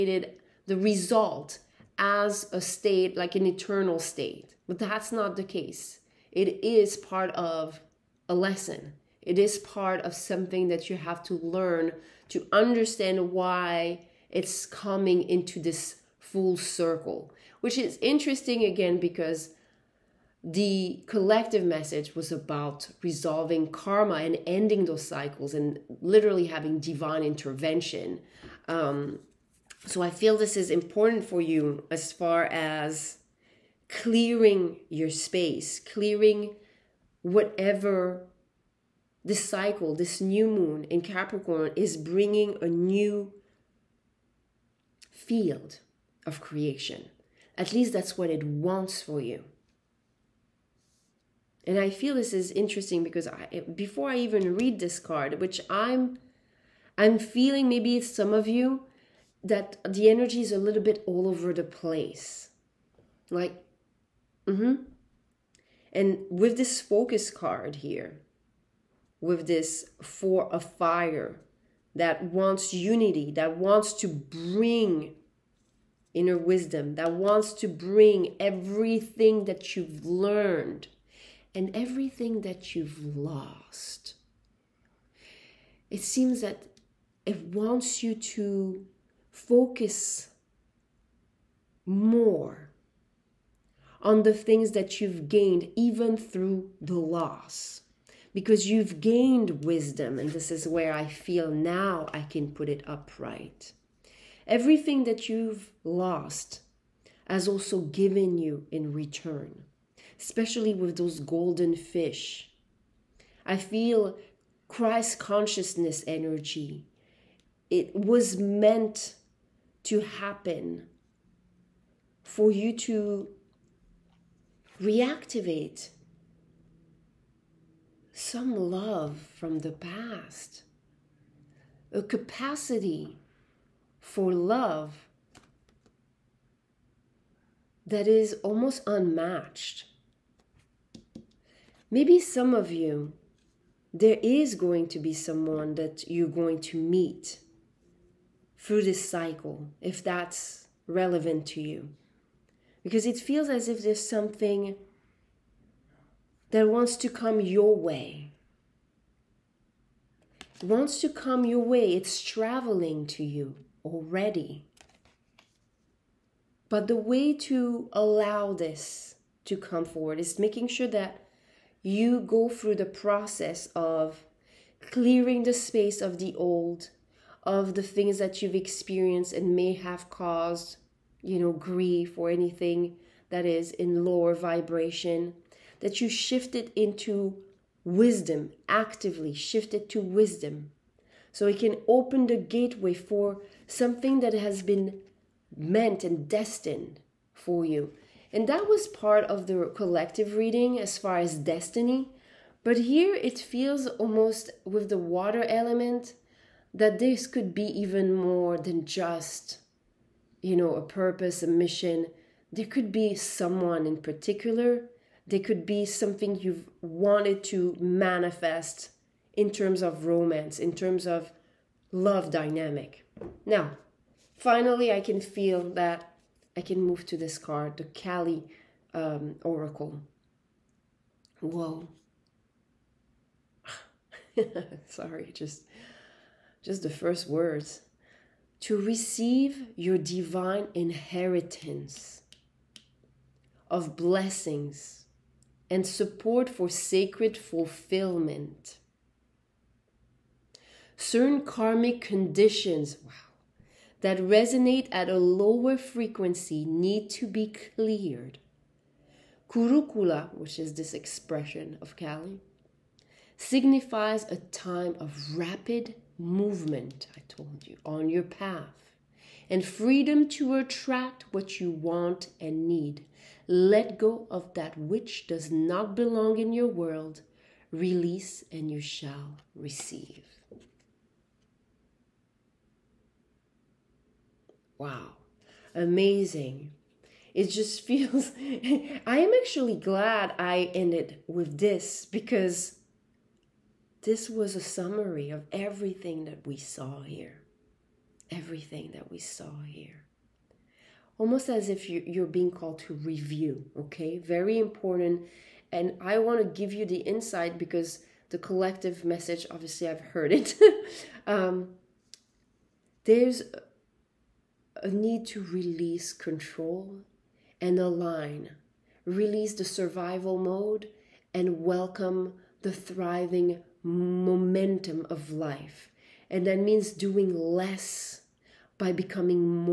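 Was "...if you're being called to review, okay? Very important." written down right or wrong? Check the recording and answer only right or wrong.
right.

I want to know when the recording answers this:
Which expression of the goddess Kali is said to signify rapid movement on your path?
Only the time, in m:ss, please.
4:19.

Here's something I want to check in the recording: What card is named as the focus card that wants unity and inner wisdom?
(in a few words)
Four of fire.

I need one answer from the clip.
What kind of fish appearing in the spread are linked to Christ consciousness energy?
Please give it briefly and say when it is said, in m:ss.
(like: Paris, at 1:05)
Golden fish, at 1:51.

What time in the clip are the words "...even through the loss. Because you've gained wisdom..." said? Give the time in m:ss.
1:35.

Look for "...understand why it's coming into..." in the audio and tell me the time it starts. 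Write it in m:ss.
0:12.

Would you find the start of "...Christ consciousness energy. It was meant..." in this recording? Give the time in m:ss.
1:54.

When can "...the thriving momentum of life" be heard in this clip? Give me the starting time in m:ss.
5:22.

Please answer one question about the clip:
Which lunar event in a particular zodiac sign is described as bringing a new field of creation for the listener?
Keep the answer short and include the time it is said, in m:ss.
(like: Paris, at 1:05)
New moon in Capricorn, at 0:40.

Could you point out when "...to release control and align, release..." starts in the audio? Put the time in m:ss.
5:15.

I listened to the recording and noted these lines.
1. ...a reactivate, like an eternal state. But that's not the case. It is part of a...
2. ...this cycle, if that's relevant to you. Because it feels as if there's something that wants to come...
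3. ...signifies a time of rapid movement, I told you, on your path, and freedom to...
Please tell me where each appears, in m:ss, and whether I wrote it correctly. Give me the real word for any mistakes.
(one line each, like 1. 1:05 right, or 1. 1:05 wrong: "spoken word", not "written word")
1. 0:02 wrong: "state", not "reactivate"
2. 2:28 right
3. 4:23 right.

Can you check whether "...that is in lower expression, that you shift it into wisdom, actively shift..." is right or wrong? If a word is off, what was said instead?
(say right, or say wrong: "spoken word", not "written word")
wrong: "vibration", not "expression".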